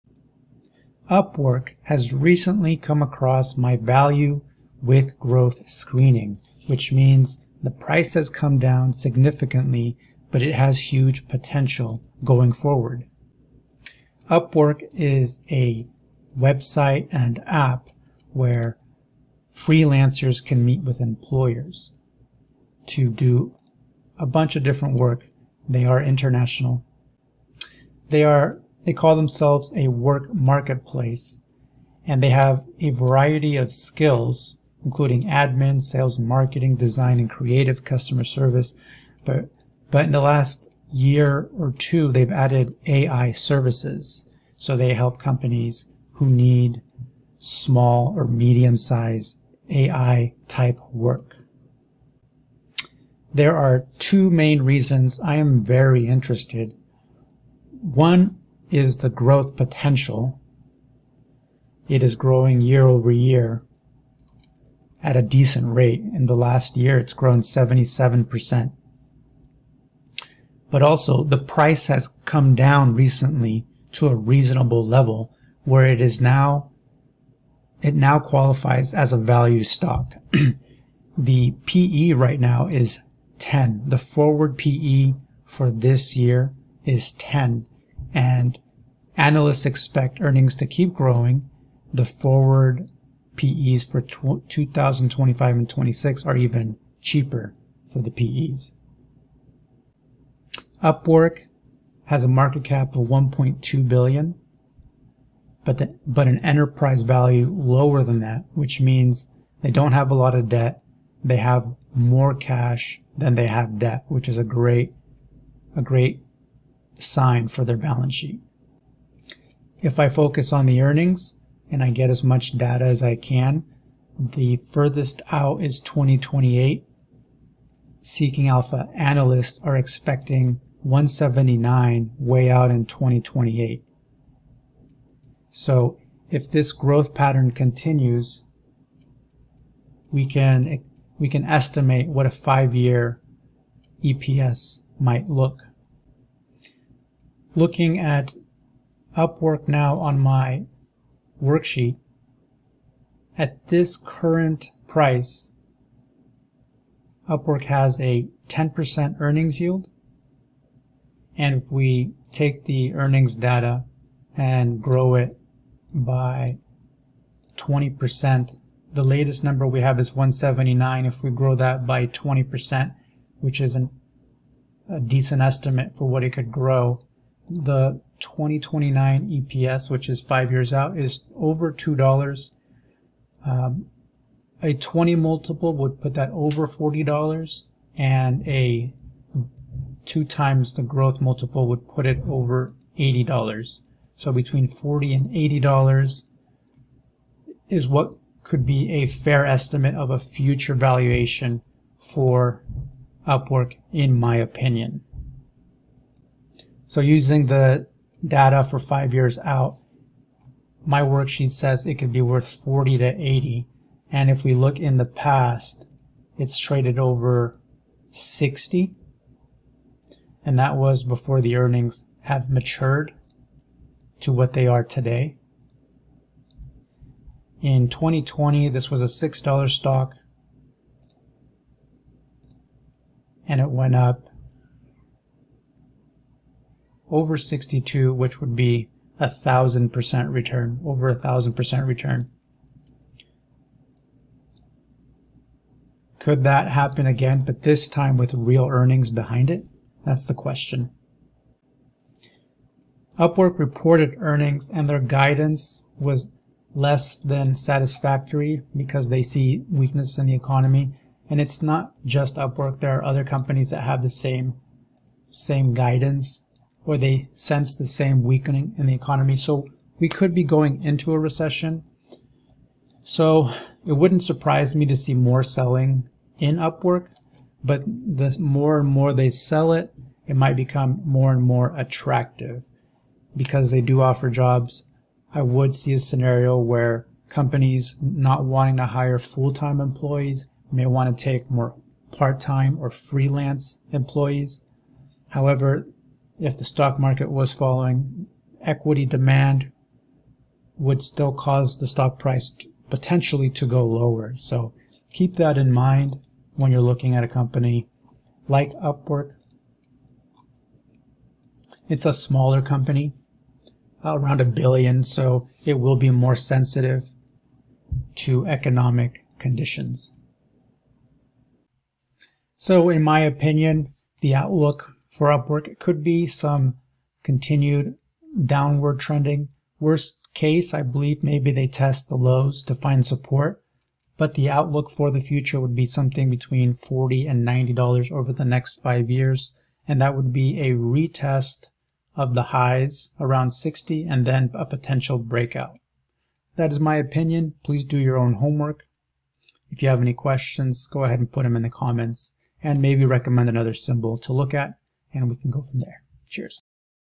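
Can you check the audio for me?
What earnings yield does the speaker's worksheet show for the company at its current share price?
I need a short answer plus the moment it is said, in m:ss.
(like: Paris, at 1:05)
10%, at 2:38.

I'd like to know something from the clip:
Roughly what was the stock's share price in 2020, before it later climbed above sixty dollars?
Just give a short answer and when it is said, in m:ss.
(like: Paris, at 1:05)
$6, at 3:49.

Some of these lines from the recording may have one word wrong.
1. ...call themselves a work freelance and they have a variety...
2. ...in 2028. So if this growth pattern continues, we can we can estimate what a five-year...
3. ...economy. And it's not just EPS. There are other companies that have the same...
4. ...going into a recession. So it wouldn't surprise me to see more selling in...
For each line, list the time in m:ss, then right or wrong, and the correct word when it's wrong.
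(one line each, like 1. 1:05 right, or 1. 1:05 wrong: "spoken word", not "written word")
1. 0:28 wrong: "marketplace", not "freelance"
2. 2:12 right
3. 4:20 wrong: "Upwork", not "EPS"
4. 4:30 right.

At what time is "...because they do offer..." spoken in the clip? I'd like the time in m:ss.
4:43.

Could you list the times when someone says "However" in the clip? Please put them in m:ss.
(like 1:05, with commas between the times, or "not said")
4:55.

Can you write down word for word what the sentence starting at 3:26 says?
So using the data for five years out, my worksheet says it could be worth 40 to 80.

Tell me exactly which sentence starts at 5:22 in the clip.
So in my opinion, the outlook for Upwork.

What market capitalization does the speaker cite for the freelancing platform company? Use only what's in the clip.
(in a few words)
1.2 billion.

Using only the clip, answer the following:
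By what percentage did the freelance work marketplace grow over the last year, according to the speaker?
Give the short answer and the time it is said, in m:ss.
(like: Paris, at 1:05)
77%, at 1:07.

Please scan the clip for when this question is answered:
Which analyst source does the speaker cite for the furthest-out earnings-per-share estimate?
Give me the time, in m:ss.
2:08.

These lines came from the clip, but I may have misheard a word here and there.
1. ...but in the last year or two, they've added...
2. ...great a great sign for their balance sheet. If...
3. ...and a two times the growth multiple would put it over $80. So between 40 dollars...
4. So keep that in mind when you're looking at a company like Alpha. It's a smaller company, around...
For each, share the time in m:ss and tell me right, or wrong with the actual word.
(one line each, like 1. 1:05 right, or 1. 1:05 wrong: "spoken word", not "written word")
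1. 0:39 right
2. 1:54 right
3. 3:07 right
4. 5:04 wrong: "Upwork", not "Alpha".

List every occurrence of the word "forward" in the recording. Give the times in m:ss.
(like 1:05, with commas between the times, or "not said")
0:12, 1:23, 1:32.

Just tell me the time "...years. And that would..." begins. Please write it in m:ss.
5:39.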